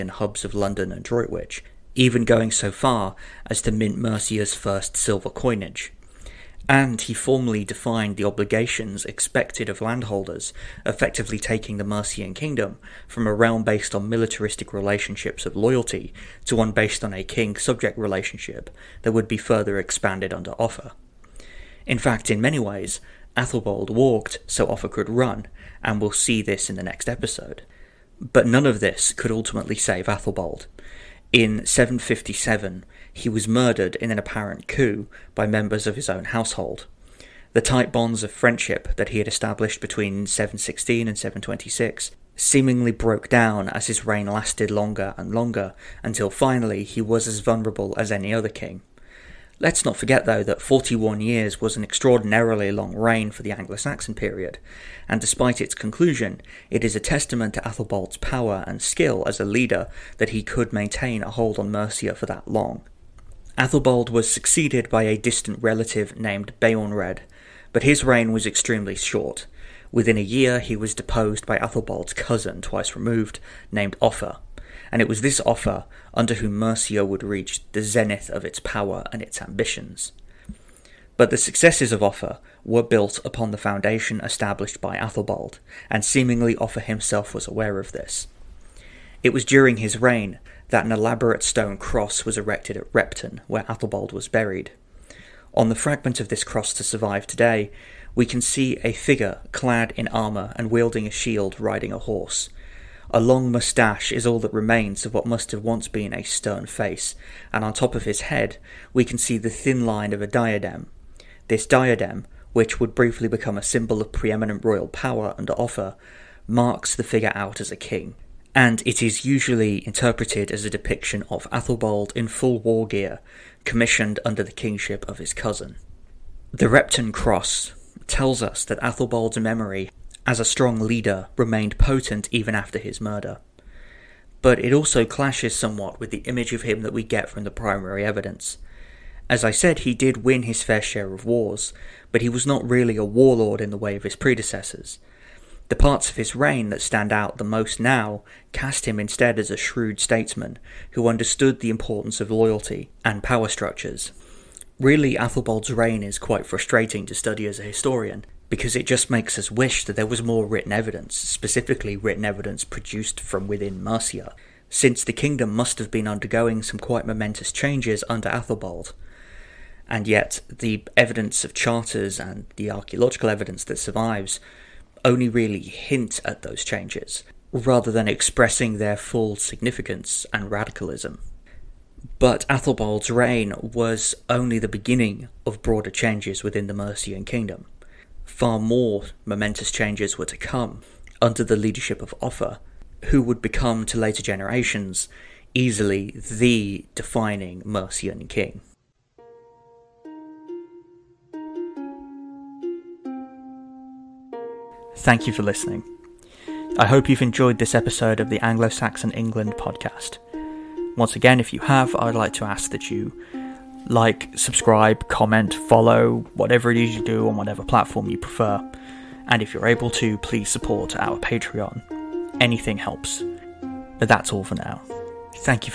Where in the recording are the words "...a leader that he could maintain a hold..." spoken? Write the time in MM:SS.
00:59.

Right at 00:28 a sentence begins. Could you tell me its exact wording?
But none of this could ultimately save Athelbald.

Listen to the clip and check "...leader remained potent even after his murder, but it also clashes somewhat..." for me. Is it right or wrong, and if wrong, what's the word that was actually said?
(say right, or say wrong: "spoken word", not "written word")
right.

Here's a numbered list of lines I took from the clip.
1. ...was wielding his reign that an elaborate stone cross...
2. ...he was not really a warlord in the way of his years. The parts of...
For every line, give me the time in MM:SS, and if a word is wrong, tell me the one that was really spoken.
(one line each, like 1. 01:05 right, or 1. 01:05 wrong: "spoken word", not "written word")
1. 01:29 wrong: "during", not "wielding"
2. 02:22 wrong: "predecessors", not "years".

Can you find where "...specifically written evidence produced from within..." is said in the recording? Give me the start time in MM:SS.
02:41.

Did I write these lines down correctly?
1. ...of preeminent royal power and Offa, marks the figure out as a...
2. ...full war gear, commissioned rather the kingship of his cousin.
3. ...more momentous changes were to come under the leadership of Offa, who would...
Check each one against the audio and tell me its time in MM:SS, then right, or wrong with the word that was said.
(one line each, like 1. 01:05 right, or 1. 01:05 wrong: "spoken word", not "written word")
1. 01:53 right
2. 02:02 wrong: "under", not "rather"
3. 03:08 right.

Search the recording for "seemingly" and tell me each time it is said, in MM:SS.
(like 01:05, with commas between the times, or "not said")
00:42, 01:26.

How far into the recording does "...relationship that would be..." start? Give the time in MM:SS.
00:17.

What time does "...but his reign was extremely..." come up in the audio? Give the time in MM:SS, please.
01:07.